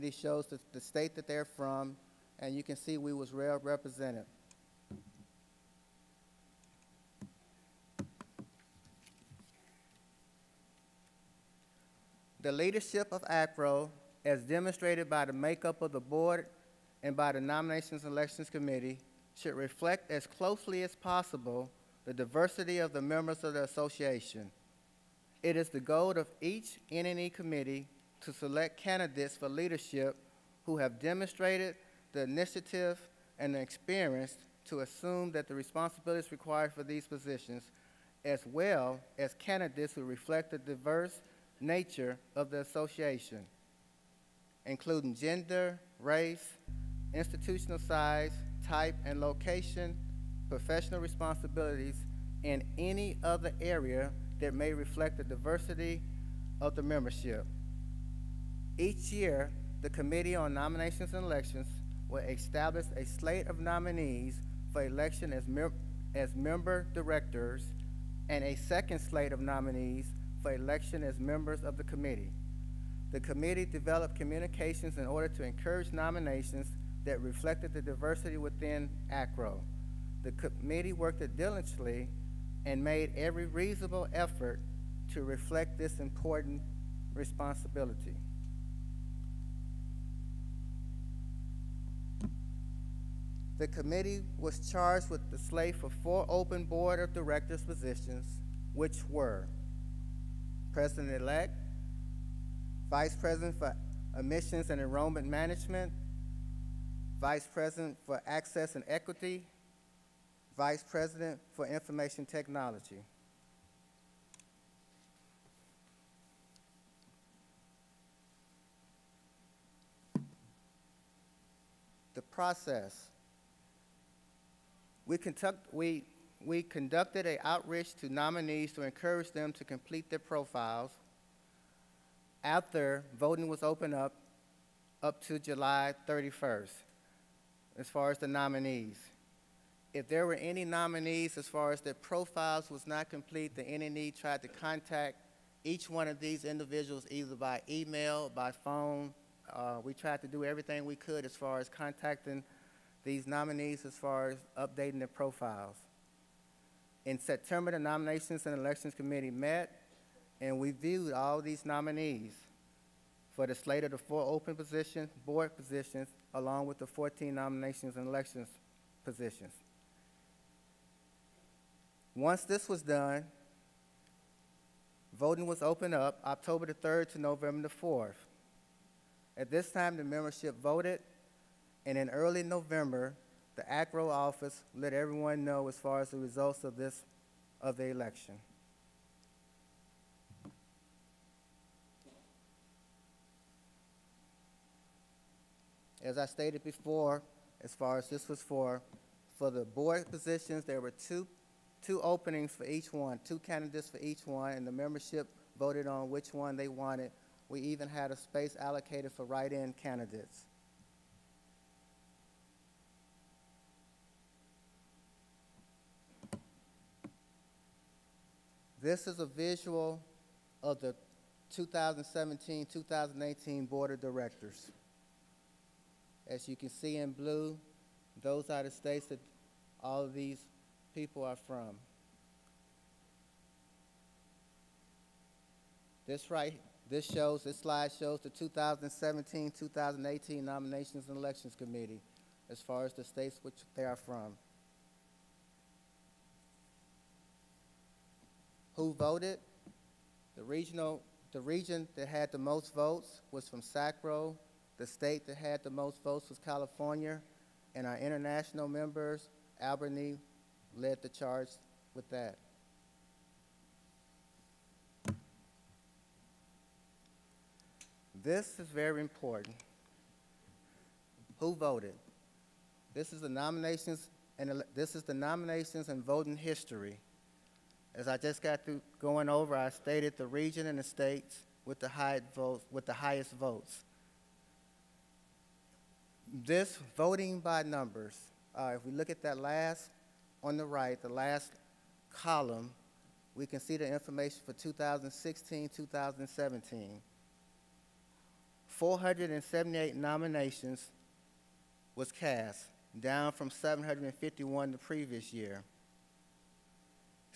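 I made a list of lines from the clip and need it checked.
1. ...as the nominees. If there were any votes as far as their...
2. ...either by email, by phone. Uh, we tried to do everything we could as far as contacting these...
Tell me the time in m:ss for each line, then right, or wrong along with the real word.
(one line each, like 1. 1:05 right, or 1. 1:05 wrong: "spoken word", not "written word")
1. 2:18 wrong: "nominees", not "votes"
2. 2:27 right.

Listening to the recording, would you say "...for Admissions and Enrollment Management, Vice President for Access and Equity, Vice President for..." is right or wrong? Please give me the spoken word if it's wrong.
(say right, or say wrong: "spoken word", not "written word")
right.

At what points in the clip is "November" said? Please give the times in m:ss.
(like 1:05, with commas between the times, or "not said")
2:57, 3:02.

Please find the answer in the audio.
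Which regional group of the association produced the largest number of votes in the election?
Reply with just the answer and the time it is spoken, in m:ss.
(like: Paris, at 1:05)
SACRAO, at 4:13.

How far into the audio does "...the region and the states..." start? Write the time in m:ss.
4:40.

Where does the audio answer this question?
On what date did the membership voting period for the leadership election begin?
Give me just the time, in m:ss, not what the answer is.
2:56.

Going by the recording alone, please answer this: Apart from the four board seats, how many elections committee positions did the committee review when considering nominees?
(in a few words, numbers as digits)
14.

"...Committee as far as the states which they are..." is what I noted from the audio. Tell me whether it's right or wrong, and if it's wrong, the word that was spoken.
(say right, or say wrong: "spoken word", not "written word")
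right.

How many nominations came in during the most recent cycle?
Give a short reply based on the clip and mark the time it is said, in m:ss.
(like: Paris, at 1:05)
478, at 4:58.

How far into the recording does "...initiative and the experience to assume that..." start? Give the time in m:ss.
0:32.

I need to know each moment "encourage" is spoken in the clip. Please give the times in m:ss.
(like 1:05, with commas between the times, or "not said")
1:15, 2:08.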